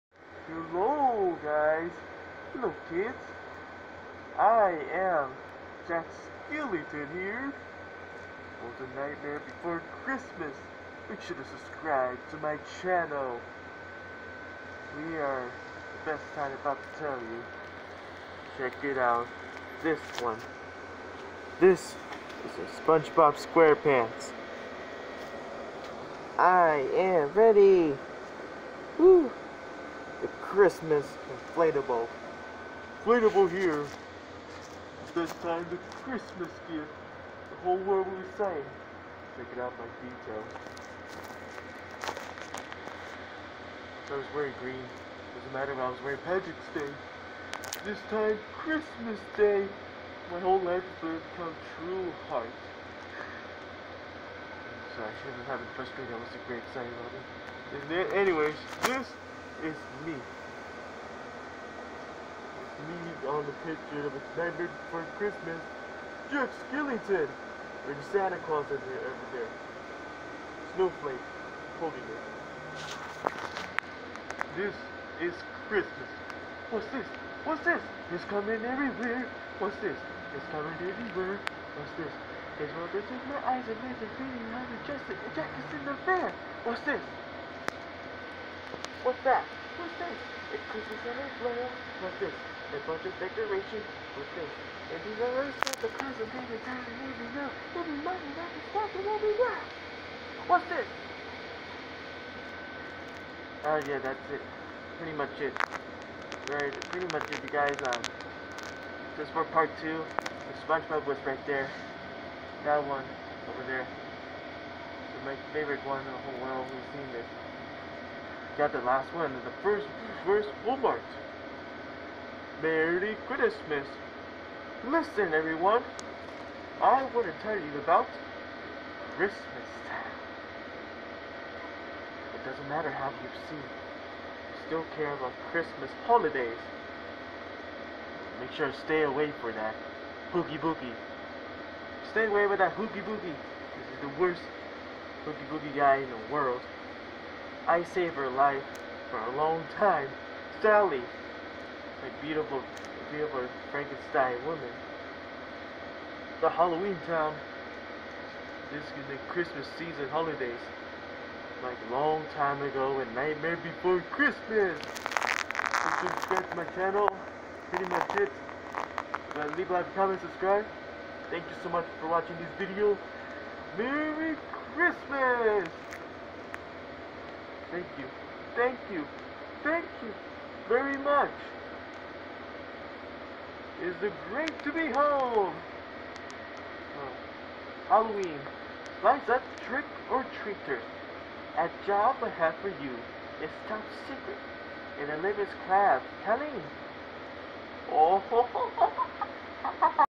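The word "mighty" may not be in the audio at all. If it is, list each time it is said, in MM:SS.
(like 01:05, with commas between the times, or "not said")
01:37.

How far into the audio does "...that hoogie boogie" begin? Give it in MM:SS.
02:22.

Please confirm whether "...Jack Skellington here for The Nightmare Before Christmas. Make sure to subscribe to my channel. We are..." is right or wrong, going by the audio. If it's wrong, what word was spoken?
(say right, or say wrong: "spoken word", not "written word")
right.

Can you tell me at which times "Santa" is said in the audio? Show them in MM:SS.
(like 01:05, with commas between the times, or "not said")
01:08.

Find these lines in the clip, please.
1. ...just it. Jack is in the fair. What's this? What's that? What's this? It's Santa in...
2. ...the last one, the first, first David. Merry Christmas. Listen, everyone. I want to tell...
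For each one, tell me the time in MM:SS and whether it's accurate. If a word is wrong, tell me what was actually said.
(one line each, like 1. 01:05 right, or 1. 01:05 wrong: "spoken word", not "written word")
1. 01:24 wrong: "Christmas", not "Santa"
2. 01:58 wrong: "Walmart", not "David".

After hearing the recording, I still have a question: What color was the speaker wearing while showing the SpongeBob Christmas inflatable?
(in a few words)
green.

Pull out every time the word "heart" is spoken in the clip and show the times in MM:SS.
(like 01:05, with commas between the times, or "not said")
00:52.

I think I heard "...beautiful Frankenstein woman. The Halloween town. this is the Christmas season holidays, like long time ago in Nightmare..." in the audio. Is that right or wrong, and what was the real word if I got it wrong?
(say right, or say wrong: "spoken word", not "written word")
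right.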